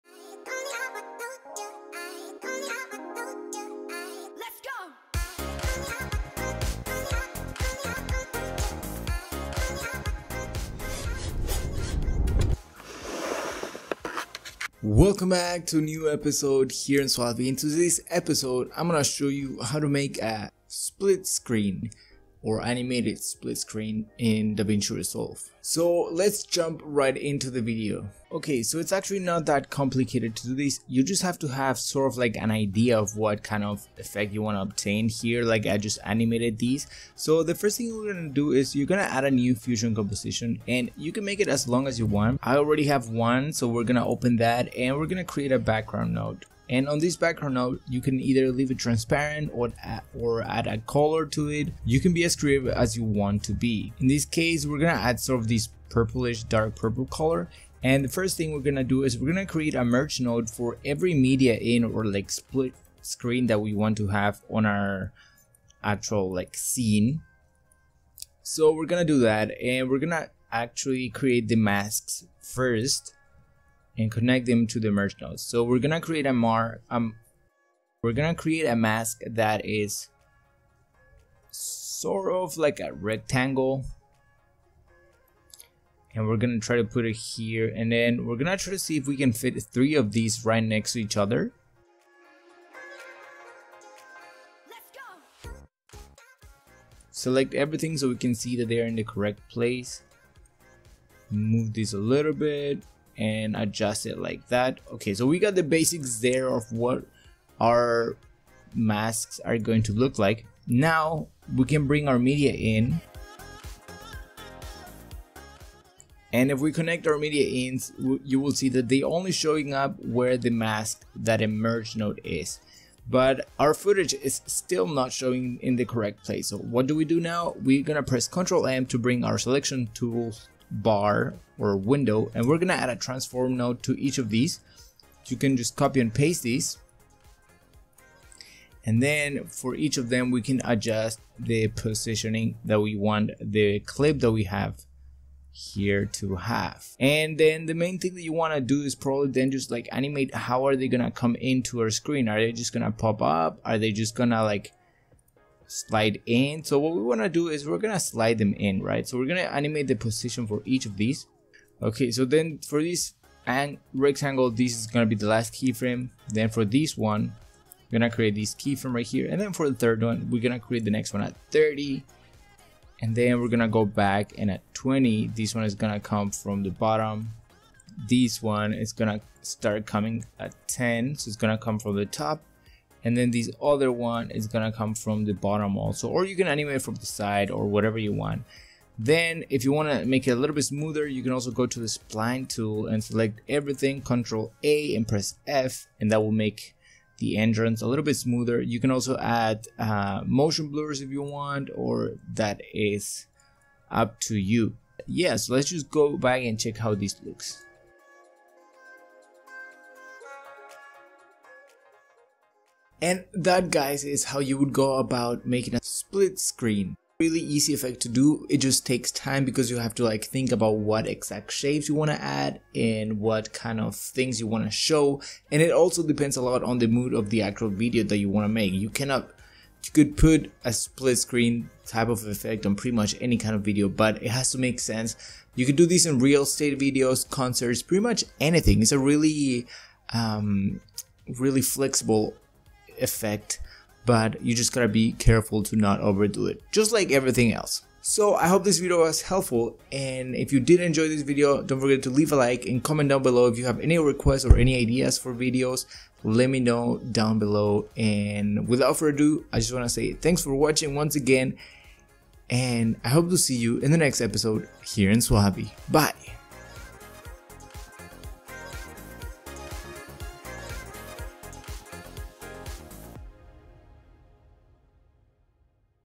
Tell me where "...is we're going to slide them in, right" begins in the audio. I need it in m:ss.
2:37.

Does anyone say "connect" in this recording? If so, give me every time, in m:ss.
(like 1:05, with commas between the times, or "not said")
1:14, 1:56.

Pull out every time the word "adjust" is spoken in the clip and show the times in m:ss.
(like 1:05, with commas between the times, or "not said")
1:43, 2:20.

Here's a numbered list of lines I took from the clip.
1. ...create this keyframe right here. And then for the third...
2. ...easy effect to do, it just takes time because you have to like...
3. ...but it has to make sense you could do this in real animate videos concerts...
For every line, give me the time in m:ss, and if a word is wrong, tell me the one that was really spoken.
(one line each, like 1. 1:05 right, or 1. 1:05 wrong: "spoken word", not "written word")
1. 2:48 right
2. 3:37 right
3. 3:53 wrong: "estate", not "animate".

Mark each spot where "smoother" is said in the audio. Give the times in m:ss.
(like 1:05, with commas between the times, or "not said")
3:10, 3:18.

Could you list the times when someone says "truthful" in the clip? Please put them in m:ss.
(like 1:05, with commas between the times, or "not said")
not said.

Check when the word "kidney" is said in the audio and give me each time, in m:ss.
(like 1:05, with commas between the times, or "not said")
not said.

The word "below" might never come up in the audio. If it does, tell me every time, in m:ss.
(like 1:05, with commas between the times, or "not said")
4:13, 4:17.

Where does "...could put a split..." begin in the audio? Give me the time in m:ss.
3:49.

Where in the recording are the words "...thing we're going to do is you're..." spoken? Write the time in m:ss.
0:37.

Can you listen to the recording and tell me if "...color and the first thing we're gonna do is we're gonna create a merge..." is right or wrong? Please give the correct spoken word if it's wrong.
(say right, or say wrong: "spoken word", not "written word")
right.